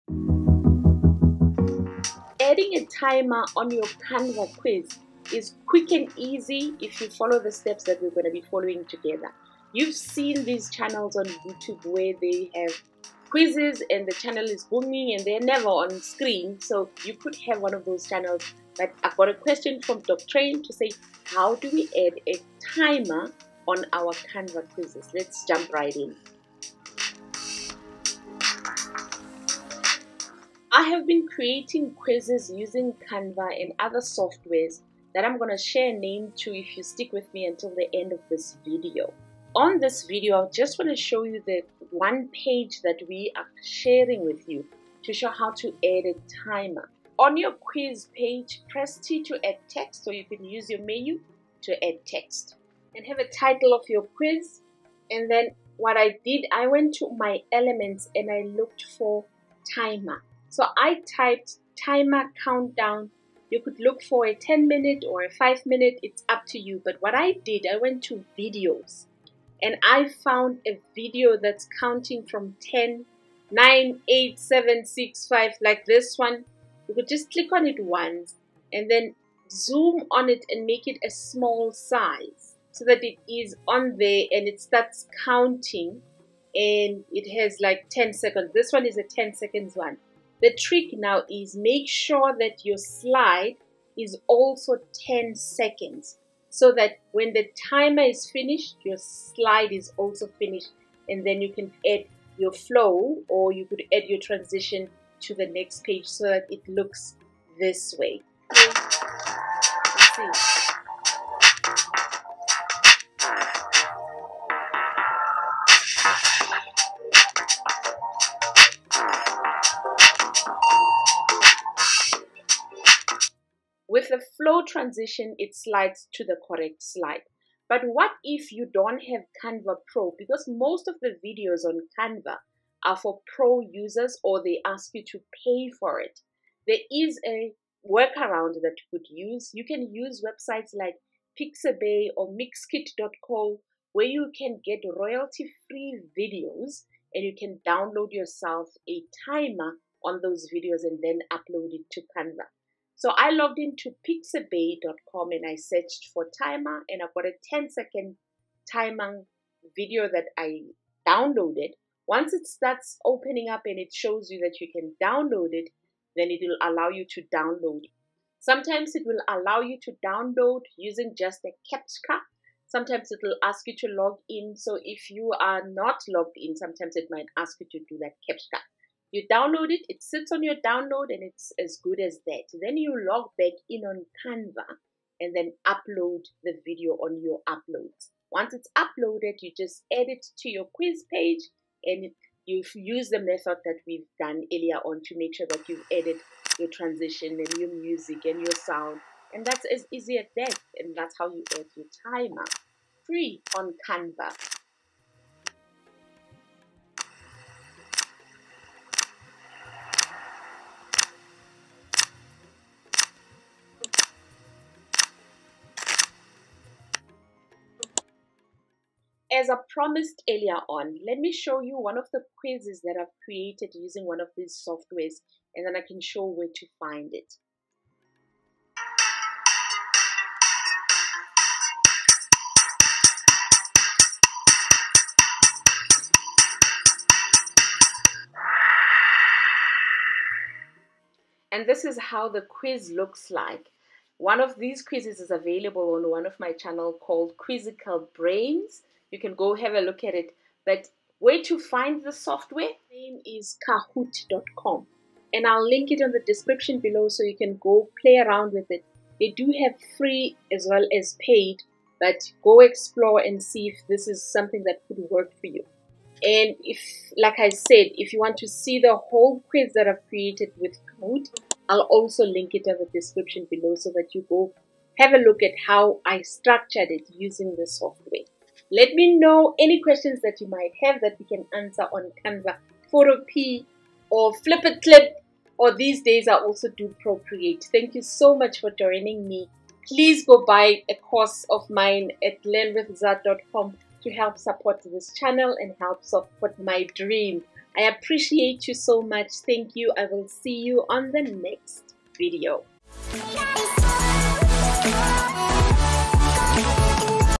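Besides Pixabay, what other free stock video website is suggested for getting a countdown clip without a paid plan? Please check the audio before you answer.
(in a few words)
Mixkit.co.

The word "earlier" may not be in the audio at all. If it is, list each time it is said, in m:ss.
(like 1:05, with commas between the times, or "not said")
3:14, 3:40.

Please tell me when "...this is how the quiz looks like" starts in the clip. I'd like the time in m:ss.
4:01.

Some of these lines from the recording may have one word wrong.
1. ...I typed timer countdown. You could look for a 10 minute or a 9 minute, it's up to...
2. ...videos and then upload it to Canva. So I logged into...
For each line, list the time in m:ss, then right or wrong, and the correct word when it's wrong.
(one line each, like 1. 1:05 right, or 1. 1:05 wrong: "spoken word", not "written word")
1. 1:00 wrong: "5", not "9"
2. 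2:30 right.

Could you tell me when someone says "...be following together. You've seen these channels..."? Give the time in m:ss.
0:08.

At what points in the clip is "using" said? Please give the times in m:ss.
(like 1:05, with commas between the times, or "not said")
0:32, 2:50, 3:43, 4:37.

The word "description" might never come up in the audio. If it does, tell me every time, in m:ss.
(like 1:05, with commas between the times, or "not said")
4:16, 4:32.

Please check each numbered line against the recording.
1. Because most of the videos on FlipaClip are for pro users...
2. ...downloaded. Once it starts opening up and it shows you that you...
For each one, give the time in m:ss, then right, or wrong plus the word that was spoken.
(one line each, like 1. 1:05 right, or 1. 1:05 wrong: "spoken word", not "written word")
1. 2:10 wrong: "Canva", not "FlipaClip"
2. 2:41 right.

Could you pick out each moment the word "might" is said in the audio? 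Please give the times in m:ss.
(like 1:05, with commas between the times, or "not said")
2:57, 4:40.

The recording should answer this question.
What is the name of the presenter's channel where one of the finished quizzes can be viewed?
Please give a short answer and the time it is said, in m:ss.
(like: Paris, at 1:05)
Quizzical Brains, at 4:07.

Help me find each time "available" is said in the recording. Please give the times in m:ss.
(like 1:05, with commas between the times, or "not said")
4:05.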